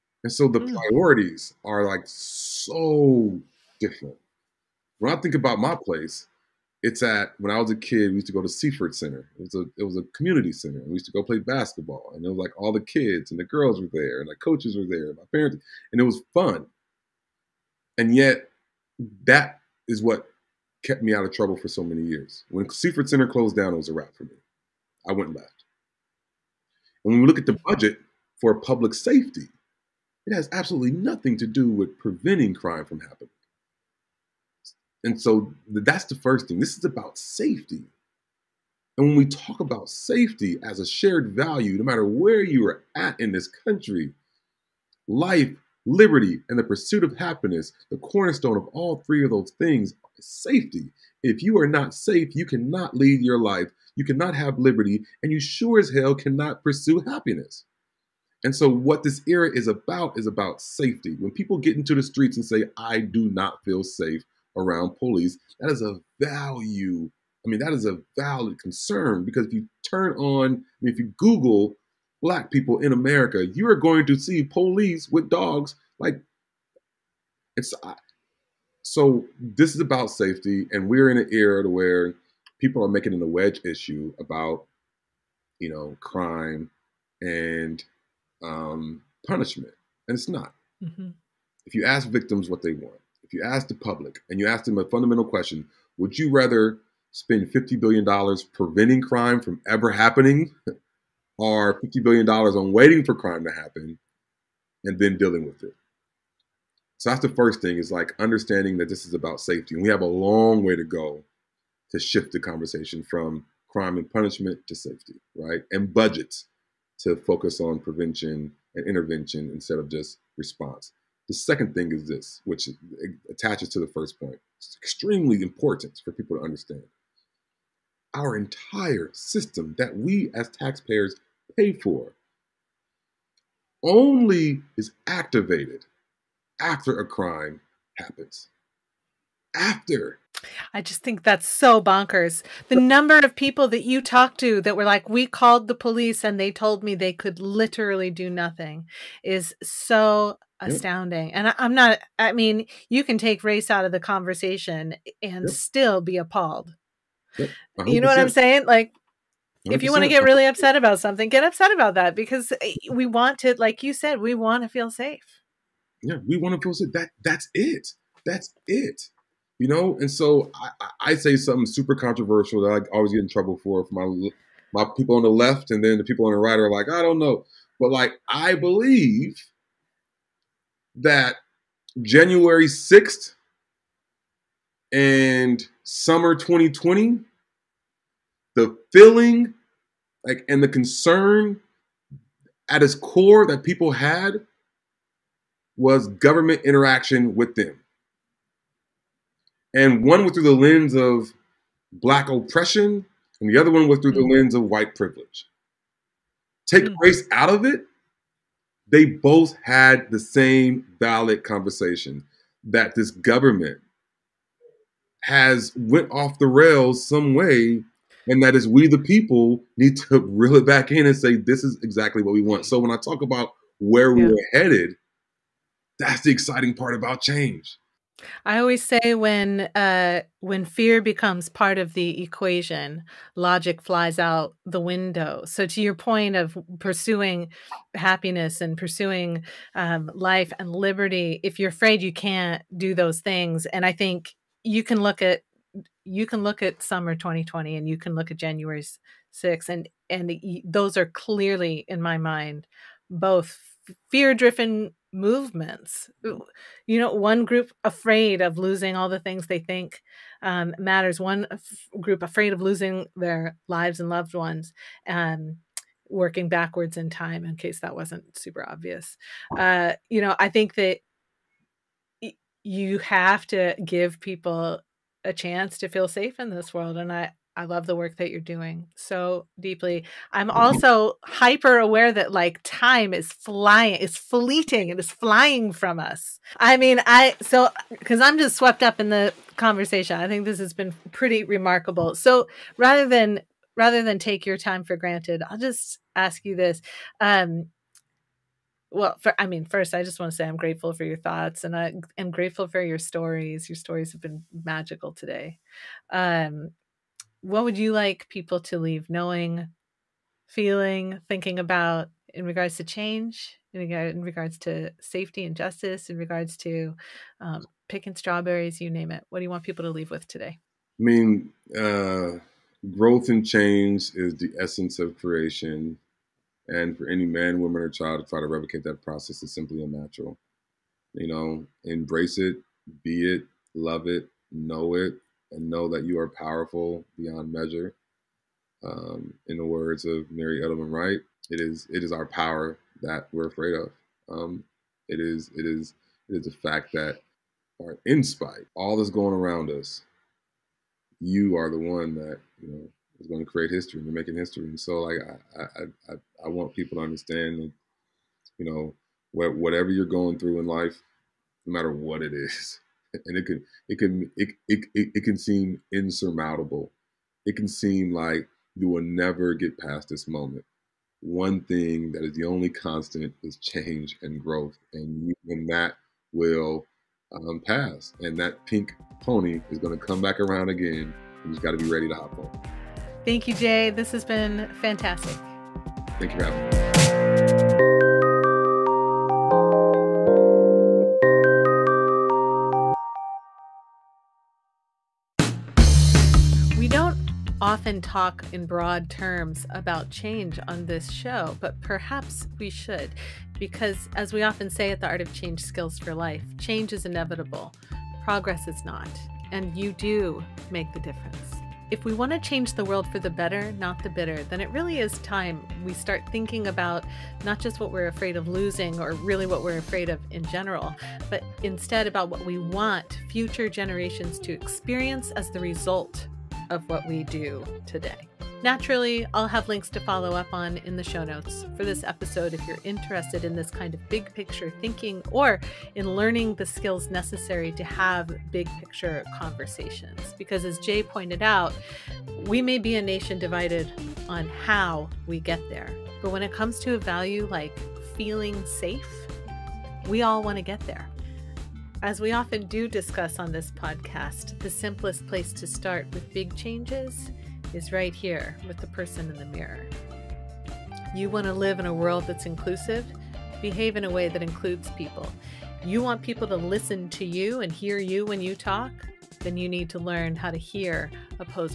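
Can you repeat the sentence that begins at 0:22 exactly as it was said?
When Seaford Center closed down, it was a wrap for me.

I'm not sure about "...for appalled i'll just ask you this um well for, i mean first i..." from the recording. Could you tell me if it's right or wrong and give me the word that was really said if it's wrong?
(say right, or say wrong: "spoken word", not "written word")
wrong: "granted", not "appalled".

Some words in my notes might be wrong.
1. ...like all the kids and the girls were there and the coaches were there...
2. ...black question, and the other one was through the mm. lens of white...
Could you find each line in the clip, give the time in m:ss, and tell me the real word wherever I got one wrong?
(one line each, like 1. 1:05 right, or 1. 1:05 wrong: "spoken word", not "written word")
1. 0:12 right
2. 3:21 wrong: "oppression", not "question".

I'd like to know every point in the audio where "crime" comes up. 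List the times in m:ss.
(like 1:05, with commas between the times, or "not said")
0:32, 1:25, 1:39, 1:43, 1:53, 2:17.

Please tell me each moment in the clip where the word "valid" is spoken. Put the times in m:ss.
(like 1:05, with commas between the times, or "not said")
1:08, 3:30.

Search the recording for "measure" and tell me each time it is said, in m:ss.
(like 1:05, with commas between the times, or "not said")
5:37.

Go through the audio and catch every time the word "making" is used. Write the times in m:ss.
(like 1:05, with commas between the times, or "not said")
1:22, 5:54.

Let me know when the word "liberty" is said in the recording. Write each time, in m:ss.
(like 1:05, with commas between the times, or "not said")
0:45, 0:54, 4:00.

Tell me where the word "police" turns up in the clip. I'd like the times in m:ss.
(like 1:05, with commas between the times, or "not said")
1:04, 1:14, 2:25.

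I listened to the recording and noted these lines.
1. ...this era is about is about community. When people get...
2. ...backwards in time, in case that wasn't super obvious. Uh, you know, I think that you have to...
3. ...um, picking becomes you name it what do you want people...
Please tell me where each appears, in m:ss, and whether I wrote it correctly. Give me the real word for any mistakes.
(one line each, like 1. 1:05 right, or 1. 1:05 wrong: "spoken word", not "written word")
1. 0:59 wrong: "safety", not "community"
2. 4:26 right
3. 5:17 wrong: "strawberries", not "becomes".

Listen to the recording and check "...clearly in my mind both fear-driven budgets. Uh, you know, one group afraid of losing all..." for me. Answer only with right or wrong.
wrong.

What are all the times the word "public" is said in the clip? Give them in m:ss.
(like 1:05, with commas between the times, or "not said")
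0:28, 1:33.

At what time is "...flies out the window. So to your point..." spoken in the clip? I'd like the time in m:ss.
3:53.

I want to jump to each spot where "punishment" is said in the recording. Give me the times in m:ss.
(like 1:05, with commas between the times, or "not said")
1:29, 1:54.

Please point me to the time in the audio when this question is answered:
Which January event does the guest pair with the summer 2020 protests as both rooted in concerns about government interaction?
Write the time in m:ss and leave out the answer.
3:02.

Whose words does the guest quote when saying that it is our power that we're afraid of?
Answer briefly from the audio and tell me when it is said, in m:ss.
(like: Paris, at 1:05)
Mary Edelman Wright, at 5:40.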